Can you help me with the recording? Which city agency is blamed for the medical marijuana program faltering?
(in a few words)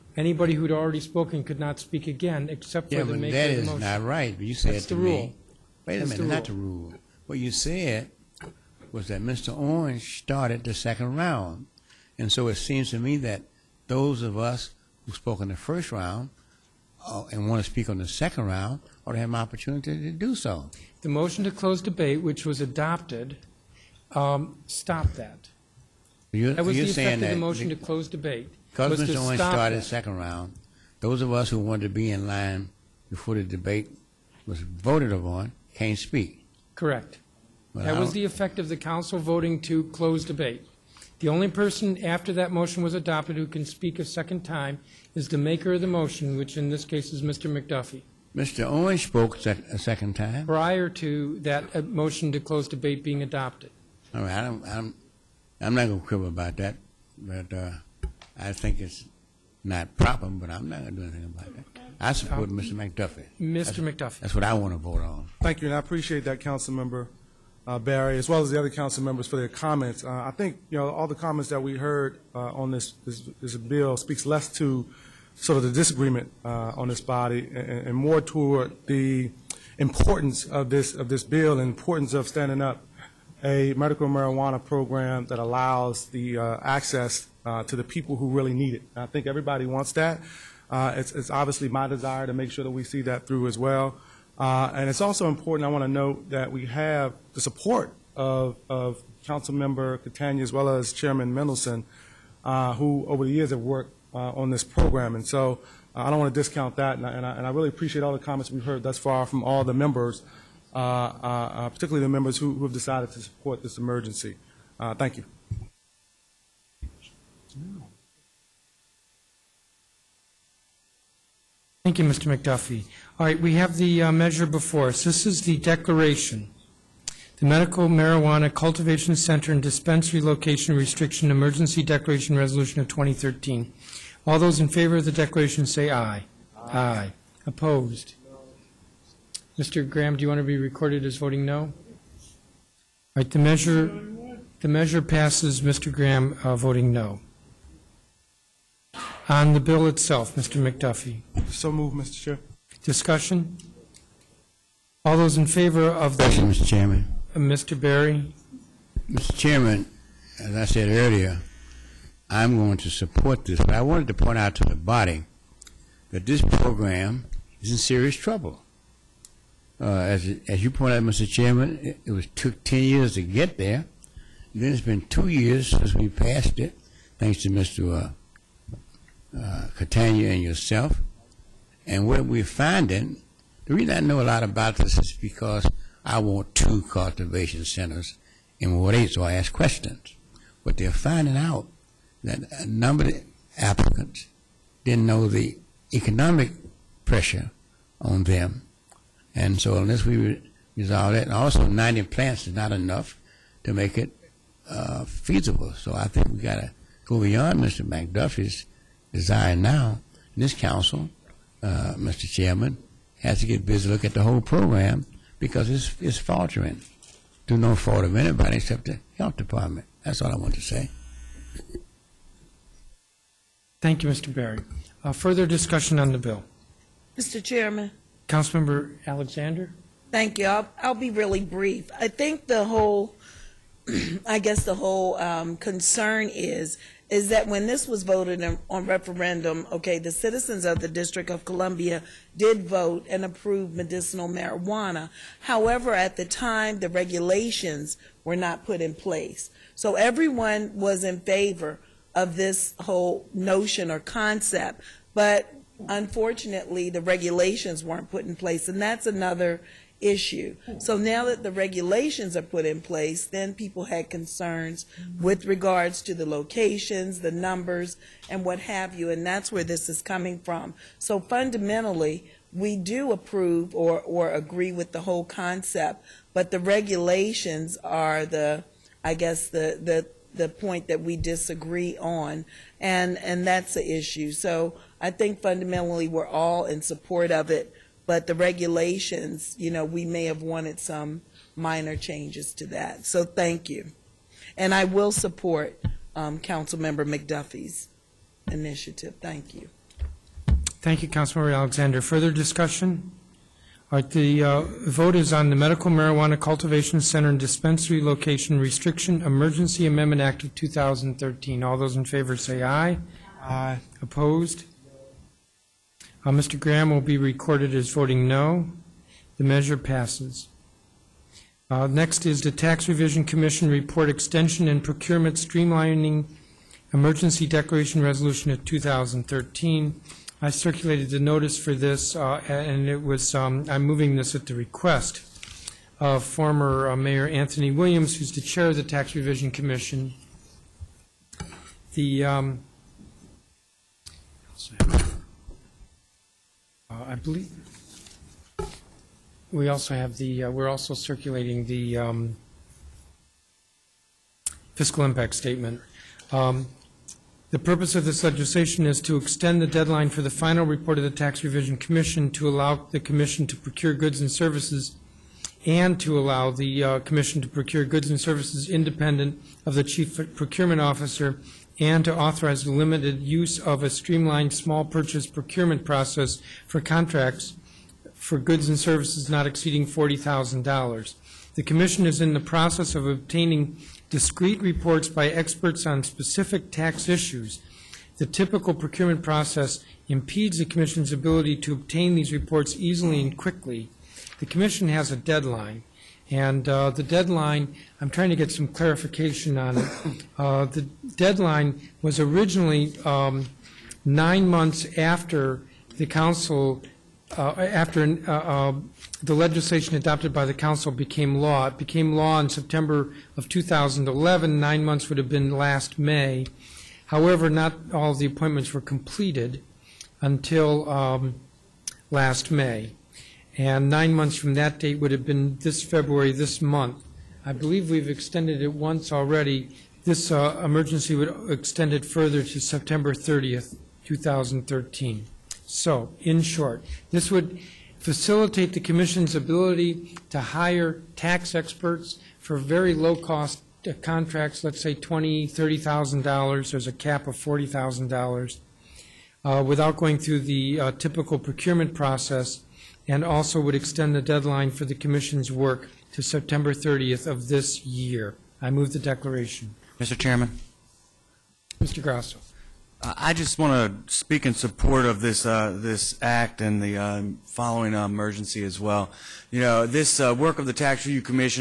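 the health department.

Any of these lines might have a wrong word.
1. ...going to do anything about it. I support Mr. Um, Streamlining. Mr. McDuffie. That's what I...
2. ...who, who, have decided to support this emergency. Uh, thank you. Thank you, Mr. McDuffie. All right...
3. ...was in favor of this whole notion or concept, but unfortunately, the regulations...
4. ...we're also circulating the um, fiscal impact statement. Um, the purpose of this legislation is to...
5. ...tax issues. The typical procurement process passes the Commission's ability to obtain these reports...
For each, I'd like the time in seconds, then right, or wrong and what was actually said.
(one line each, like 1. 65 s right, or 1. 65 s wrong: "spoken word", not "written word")
1. 60 s wrong: "McDuffie", not "Streamlining"
2. 112 s right
3. 250 s right
4. 350 s right
5. 386 s wrong: "impedes", not "passes".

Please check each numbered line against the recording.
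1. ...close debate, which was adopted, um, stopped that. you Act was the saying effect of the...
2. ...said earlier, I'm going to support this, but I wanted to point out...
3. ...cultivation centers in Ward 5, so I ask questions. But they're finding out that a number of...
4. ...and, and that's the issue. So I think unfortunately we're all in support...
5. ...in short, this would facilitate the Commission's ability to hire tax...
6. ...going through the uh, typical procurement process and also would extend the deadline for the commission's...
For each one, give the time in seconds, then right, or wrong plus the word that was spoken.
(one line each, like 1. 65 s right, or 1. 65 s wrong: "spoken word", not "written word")
1. 21 s wrong: "That", not "Act"
2. 160 s right
3. 186 s wrong: "8", not "5"
4. 282 s wrong: "fundamentally", not "unfortunately"
5. 436 s right
6. 449 s right.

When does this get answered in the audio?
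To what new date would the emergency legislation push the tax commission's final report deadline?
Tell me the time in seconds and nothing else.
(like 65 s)
432 s.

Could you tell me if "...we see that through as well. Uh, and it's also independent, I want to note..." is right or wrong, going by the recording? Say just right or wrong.
wrong.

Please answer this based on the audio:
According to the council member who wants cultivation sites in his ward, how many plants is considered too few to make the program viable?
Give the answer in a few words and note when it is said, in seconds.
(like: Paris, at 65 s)
90, at 201 s.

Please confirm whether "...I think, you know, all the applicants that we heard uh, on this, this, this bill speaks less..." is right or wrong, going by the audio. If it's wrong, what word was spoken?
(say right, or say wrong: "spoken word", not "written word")
wrong: "comments", not "applicants".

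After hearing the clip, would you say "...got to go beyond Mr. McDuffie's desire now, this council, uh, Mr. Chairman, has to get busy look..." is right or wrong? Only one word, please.
right.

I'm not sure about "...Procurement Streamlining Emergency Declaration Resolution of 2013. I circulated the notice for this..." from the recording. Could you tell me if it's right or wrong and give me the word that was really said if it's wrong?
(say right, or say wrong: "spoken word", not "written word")
right.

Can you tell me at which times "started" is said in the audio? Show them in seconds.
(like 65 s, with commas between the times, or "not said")
10 s, 29 s.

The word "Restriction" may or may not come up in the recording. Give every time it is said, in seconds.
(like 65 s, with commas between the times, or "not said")
130 s, 308 s.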